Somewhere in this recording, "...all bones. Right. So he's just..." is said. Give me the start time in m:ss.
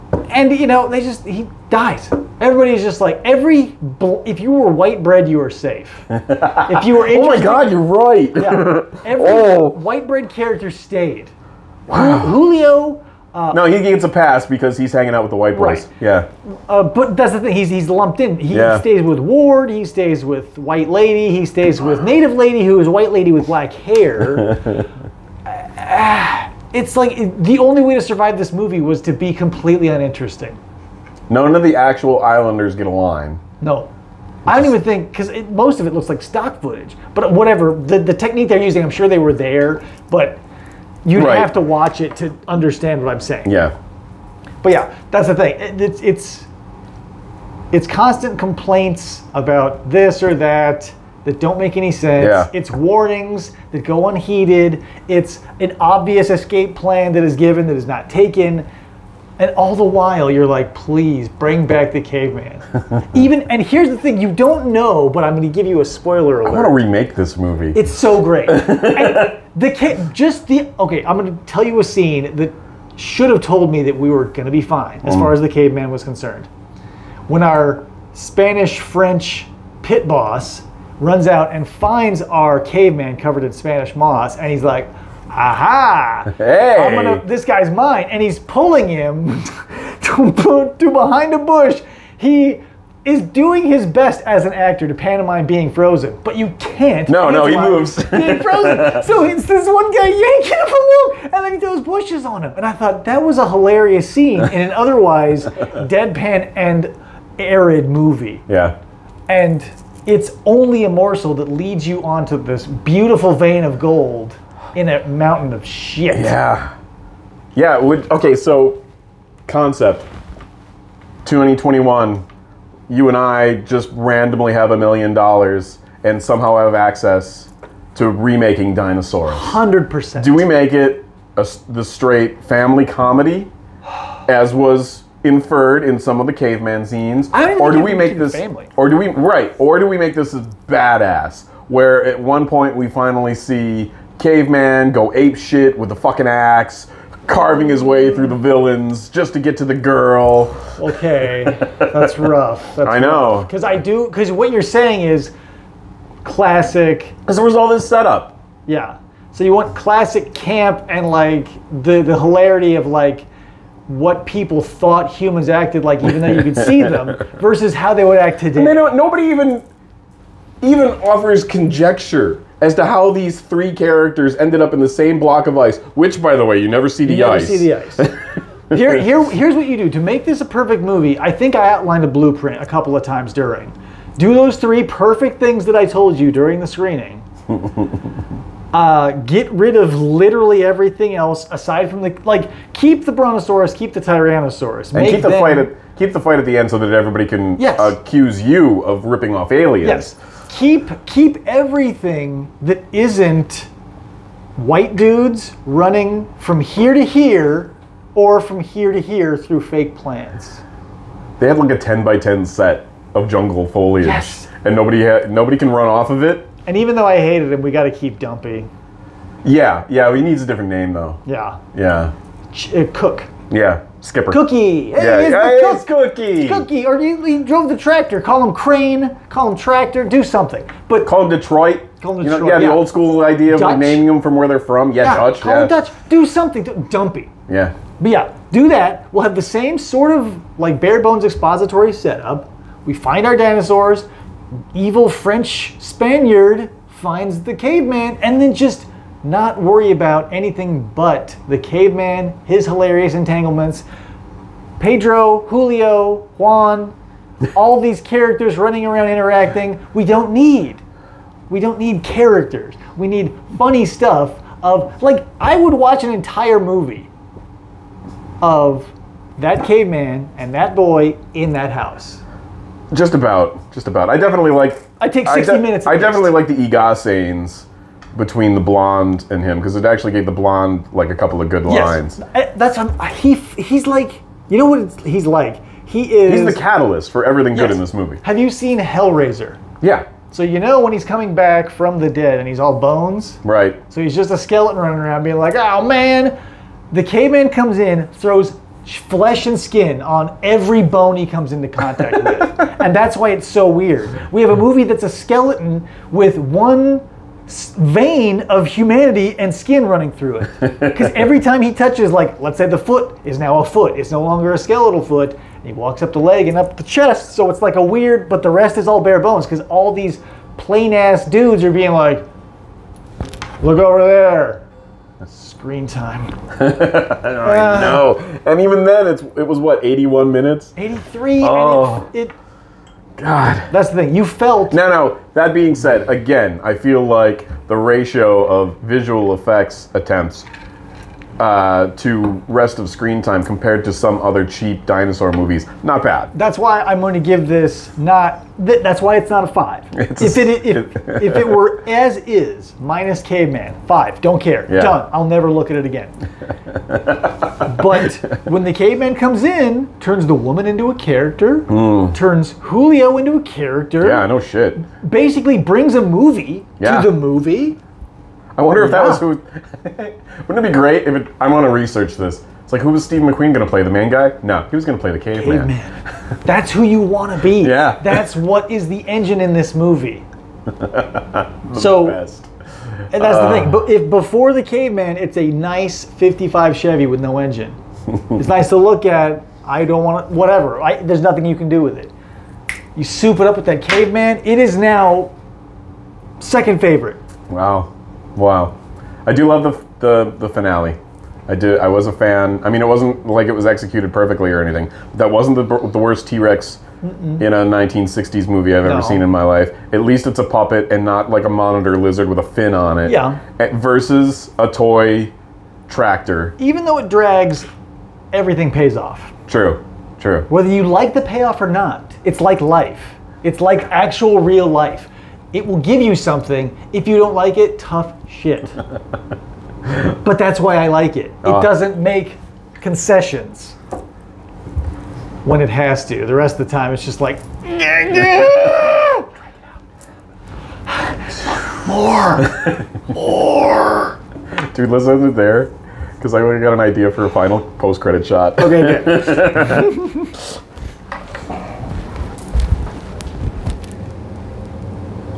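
4:52.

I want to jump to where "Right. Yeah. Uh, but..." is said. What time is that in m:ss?
0:15.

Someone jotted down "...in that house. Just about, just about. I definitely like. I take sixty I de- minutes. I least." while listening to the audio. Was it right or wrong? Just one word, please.
right.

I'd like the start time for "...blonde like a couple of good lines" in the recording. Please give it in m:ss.
4:40.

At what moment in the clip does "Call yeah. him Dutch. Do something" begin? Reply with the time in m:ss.
3:55.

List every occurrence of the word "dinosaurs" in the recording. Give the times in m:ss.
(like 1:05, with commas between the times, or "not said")
2:08, 4:03, 5:44.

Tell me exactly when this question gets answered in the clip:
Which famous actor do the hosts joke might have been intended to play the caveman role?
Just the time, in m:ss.
6:13.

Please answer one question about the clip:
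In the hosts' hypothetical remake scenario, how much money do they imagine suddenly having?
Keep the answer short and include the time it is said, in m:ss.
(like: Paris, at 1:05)
A million dollars, at 2:04.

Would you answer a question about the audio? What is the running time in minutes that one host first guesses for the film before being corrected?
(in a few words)
81.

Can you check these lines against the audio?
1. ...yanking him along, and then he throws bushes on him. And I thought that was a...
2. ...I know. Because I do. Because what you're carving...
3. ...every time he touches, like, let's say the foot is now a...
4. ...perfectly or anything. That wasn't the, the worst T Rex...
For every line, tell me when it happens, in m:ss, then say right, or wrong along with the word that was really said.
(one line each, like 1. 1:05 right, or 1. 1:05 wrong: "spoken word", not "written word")
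1. 1:40 right
2. 2:32 wrong: "saying", not "carving"
3. 5:11 right
4. 6:44 right.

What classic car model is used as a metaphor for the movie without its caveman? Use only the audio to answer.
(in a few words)
'55 Chevy.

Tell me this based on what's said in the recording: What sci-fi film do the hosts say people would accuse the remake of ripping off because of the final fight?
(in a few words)
Aliens.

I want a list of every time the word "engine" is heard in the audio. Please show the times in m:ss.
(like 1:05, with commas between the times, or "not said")
6:19, 6:27.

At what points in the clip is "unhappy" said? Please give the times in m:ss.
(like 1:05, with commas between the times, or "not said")
not said.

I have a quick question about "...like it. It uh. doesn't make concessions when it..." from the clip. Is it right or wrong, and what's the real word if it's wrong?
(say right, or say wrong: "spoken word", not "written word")
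right.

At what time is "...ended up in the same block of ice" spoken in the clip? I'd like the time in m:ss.
2:54.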